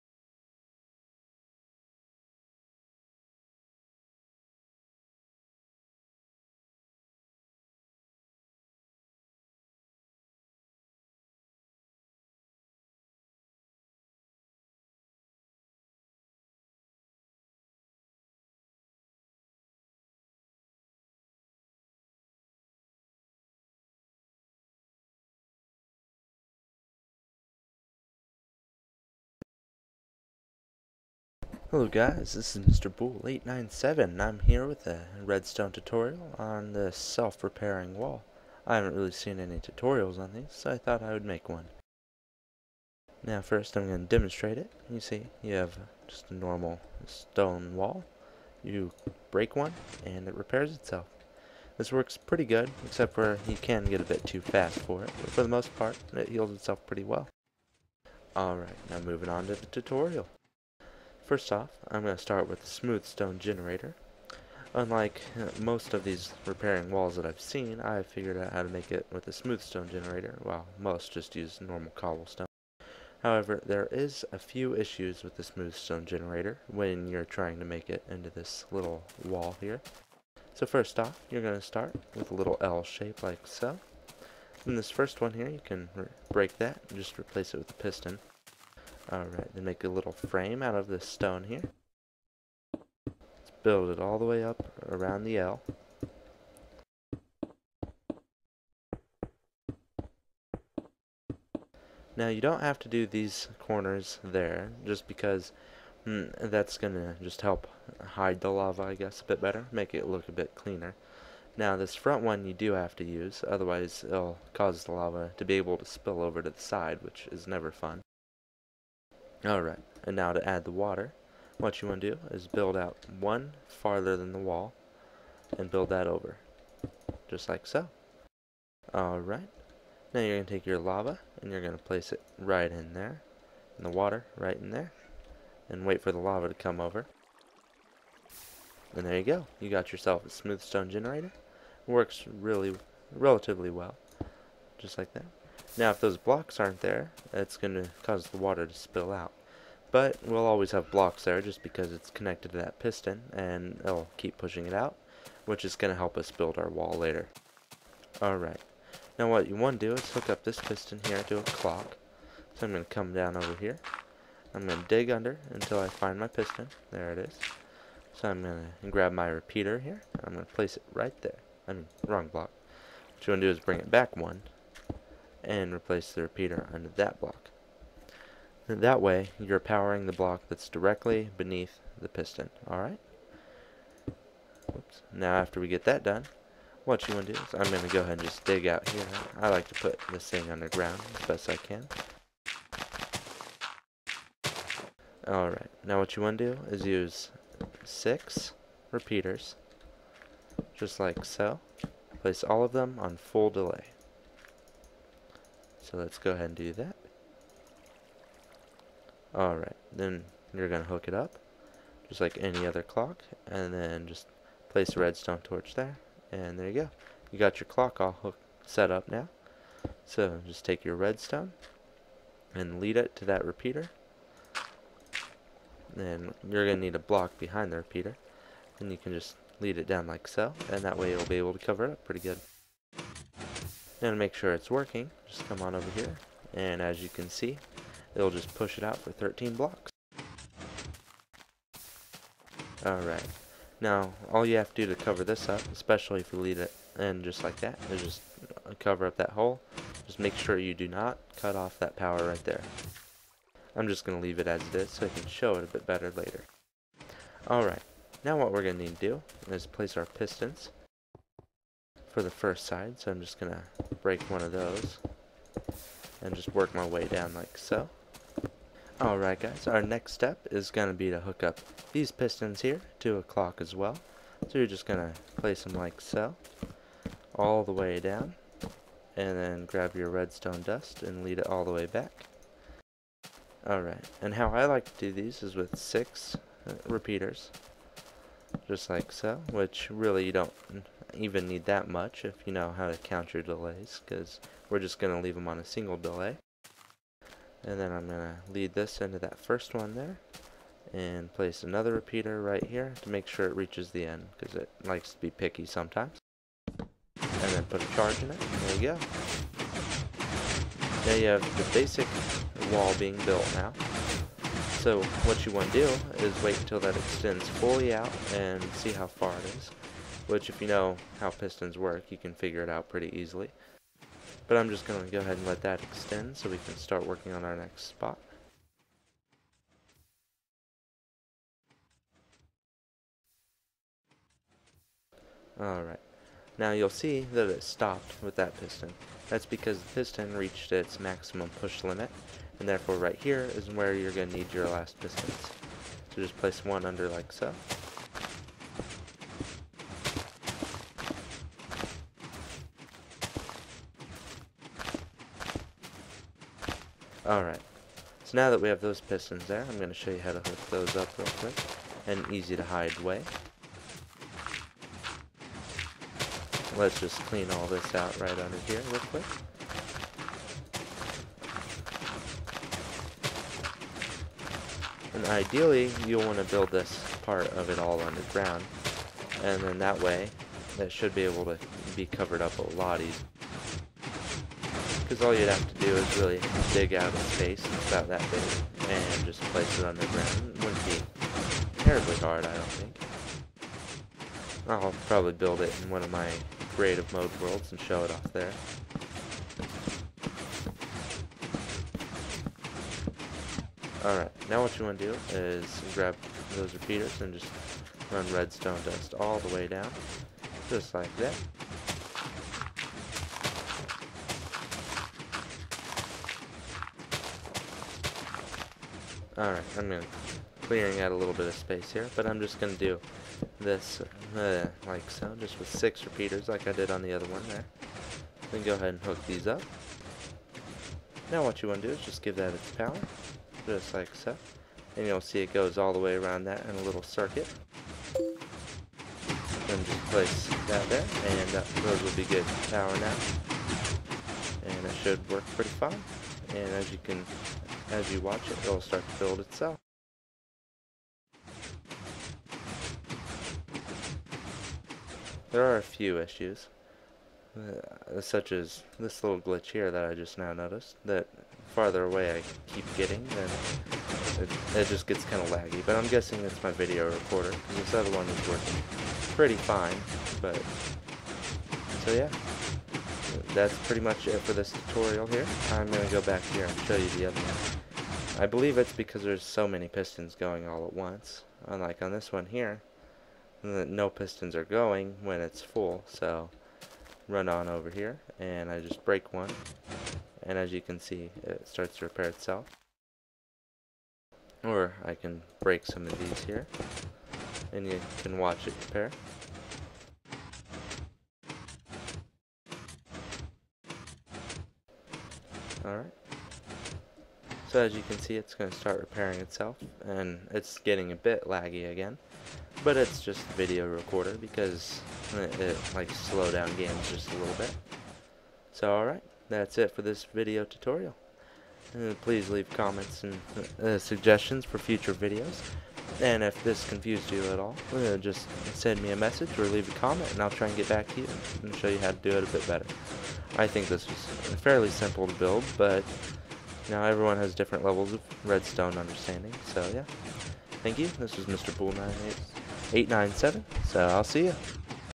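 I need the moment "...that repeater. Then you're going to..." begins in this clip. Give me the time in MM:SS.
03:43.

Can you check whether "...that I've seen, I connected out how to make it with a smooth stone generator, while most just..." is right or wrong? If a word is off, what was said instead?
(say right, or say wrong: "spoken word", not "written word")
wrong: "figured", not "connected".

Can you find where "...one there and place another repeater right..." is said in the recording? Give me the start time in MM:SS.
04:59.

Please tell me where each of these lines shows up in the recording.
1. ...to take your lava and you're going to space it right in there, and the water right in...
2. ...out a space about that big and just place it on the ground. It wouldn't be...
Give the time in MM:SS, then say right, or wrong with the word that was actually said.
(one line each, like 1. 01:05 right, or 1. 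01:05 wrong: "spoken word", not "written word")
1. 02:10 wrong: "place", not "space"
2. 06:26 right.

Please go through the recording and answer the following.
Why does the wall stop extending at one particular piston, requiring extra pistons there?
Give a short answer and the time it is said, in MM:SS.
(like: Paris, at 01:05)
Maximum push limit, at 05:40.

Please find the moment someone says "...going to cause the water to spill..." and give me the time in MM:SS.
02:27.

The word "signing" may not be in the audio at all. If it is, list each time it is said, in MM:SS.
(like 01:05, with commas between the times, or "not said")
not said.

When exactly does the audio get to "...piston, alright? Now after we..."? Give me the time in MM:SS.
03:02.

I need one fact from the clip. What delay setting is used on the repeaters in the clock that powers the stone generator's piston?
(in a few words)
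Full delay.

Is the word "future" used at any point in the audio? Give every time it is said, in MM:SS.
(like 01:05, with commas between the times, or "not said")
08:44.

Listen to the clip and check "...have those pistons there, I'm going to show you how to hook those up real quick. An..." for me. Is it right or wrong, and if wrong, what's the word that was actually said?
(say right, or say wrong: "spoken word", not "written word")
right.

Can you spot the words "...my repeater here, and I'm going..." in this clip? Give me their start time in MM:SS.
02:49.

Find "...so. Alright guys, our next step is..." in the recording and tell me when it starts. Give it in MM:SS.
04:27.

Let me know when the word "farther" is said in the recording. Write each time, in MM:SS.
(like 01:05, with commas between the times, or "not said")
02:03, 07:41.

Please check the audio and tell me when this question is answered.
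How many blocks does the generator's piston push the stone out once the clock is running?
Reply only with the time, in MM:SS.
03:59.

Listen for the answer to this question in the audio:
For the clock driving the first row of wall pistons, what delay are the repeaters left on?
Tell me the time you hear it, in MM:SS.
04:55.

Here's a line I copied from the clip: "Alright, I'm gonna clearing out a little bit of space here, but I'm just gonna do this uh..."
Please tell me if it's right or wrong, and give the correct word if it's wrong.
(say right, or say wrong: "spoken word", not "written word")
right.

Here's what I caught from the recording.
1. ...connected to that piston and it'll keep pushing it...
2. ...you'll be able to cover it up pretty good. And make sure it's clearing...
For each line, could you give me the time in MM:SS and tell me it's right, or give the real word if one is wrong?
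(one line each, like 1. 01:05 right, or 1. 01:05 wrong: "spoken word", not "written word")
1. 02:32 right
2. 03:51 wrong: "working", not "clearing".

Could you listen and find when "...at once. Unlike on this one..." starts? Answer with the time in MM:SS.
08:00.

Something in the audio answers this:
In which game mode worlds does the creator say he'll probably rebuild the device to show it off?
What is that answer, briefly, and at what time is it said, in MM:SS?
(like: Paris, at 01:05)
Creative mode, at 06:36.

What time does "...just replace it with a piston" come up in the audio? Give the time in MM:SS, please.
01:26.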